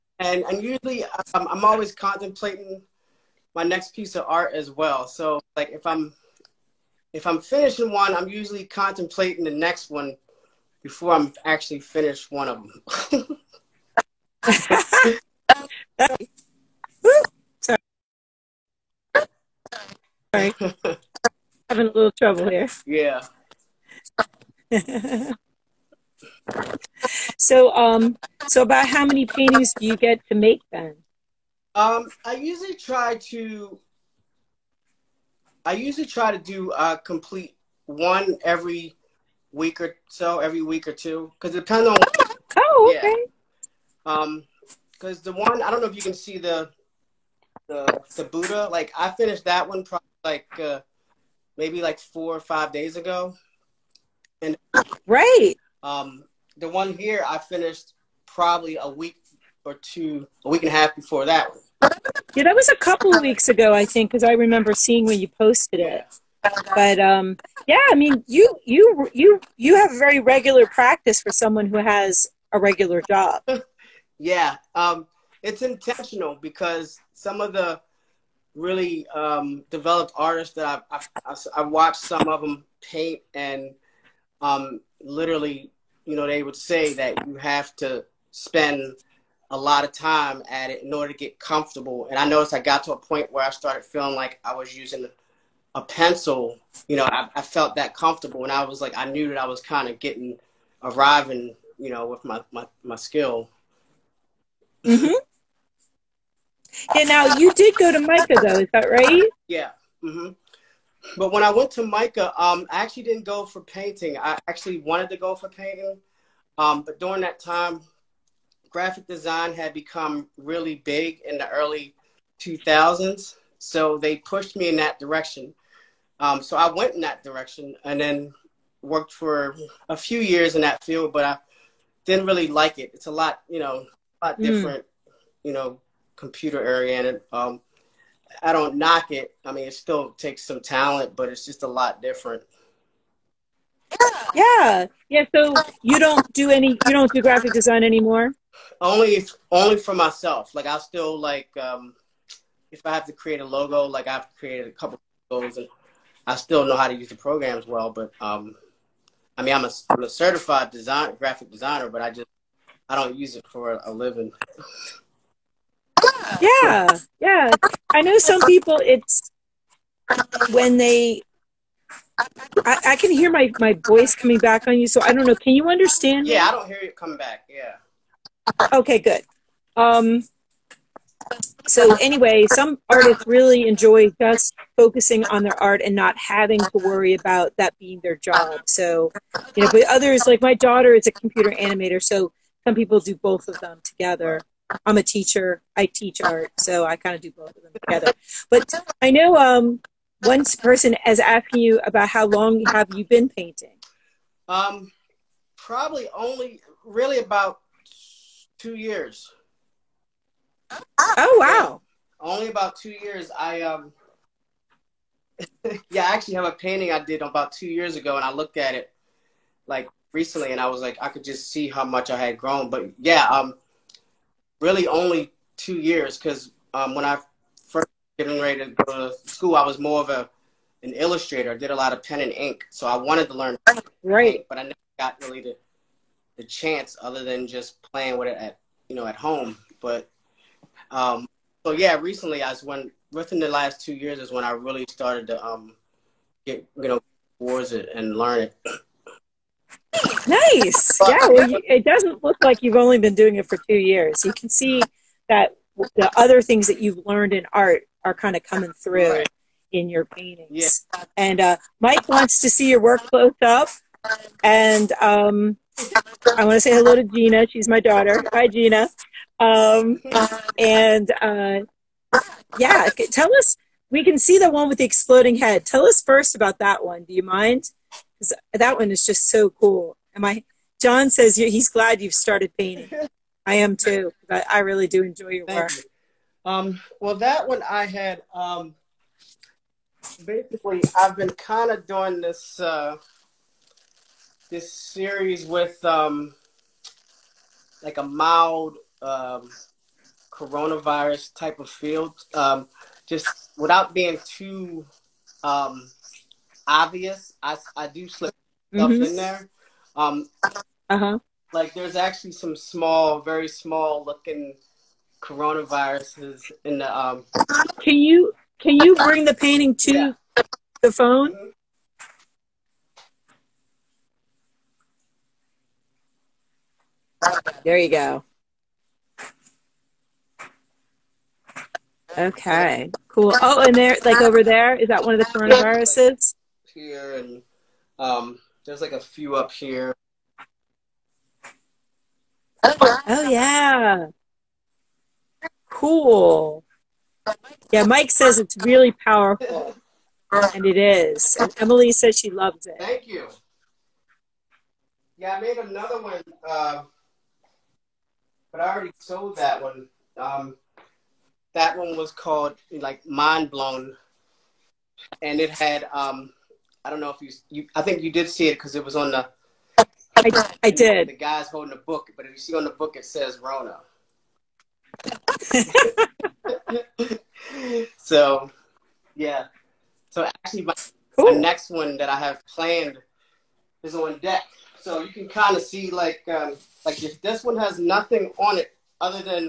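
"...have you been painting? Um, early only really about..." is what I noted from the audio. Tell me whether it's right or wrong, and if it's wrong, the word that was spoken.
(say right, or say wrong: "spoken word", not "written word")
wrong: "probably", not "early".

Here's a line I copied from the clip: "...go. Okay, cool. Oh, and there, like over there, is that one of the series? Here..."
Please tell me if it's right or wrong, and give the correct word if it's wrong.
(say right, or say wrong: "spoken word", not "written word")
wrong: "coronaviruses", not "series".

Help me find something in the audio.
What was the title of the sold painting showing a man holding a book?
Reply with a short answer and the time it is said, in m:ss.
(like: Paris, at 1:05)
Mind Blown, at 6:03.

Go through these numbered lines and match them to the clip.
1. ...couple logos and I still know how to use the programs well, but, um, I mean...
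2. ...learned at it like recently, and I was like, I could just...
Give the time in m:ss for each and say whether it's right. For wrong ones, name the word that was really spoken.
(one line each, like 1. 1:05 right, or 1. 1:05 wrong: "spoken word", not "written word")
1. 2:34 right
2. 3:38 wrong: "looked", not "learned".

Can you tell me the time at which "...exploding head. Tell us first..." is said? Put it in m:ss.
4:34.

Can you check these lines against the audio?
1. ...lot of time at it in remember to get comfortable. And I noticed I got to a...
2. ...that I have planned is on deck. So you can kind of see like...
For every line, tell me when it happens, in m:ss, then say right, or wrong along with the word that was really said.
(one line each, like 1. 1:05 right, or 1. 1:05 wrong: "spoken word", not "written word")
1. 1:29 wrong: "order", not "remember"
2. 6:21 right.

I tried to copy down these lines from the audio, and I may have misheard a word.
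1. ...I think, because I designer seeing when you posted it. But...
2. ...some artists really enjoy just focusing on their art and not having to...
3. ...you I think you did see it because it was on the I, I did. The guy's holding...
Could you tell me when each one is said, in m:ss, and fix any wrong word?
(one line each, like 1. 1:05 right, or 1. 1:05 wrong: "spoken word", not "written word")
1. 1:03 wrong: "remember", not "designer"
2. 3:02 right
3. 6:07 right.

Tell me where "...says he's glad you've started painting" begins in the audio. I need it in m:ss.
4:41.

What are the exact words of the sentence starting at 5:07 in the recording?
I I do slip stuff mm-hmm.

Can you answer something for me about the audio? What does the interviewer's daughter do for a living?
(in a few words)
computer animator.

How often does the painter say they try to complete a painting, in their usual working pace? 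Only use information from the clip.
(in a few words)
every week or so.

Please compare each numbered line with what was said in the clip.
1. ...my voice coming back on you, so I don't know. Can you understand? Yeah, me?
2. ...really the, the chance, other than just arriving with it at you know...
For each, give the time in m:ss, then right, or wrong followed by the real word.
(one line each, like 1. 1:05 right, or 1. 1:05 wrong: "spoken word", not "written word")
1. 2:53 right
2. 3:55 wrong: "playing", not "arriving".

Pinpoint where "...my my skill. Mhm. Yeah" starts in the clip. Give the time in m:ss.
1:42.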